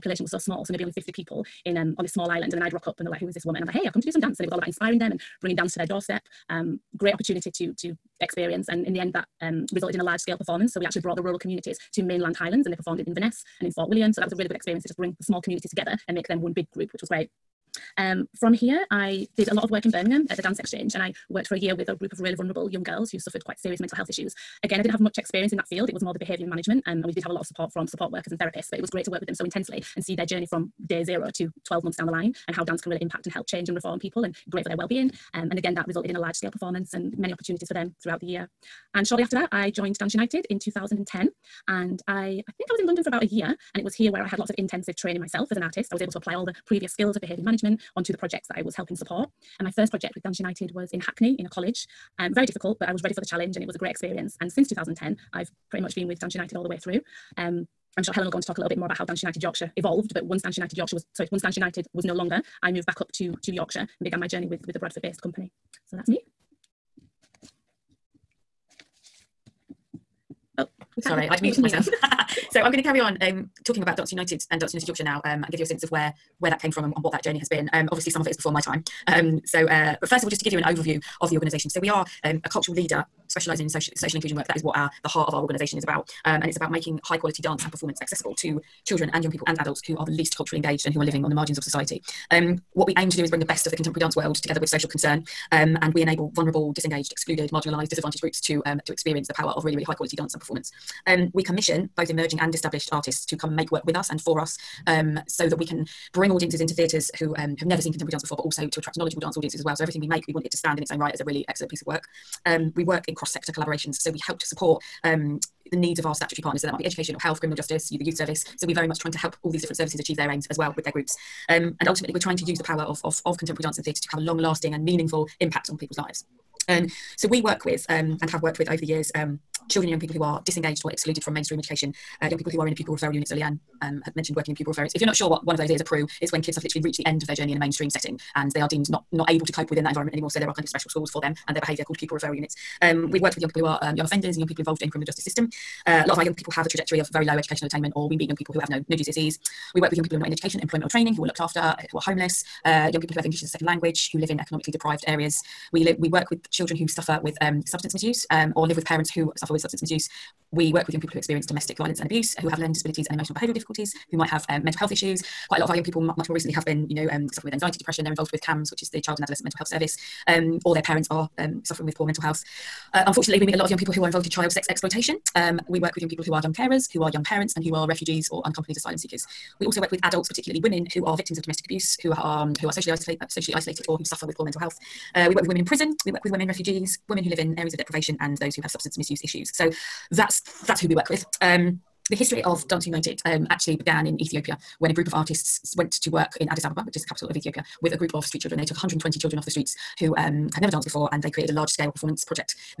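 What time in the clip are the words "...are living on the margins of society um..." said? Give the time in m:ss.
1:31.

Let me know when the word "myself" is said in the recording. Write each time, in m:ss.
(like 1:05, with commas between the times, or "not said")
0:45, 1:11.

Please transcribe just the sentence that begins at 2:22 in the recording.
Um, we've worked with young people who are um, young offenders and young people involved in criminal justice system.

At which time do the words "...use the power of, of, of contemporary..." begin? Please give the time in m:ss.
2:02.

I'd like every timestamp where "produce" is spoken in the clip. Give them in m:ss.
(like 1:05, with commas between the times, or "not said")
not said.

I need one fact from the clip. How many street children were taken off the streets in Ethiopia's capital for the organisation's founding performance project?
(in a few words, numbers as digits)
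120.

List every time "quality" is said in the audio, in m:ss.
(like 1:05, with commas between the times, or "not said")
1:27, 1:39.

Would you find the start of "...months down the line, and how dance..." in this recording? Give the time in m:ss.
0:31.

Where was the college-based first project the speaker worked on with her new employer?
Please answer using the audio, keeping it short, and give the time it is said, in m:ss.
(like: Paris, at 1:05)
Hackney, at 0:51.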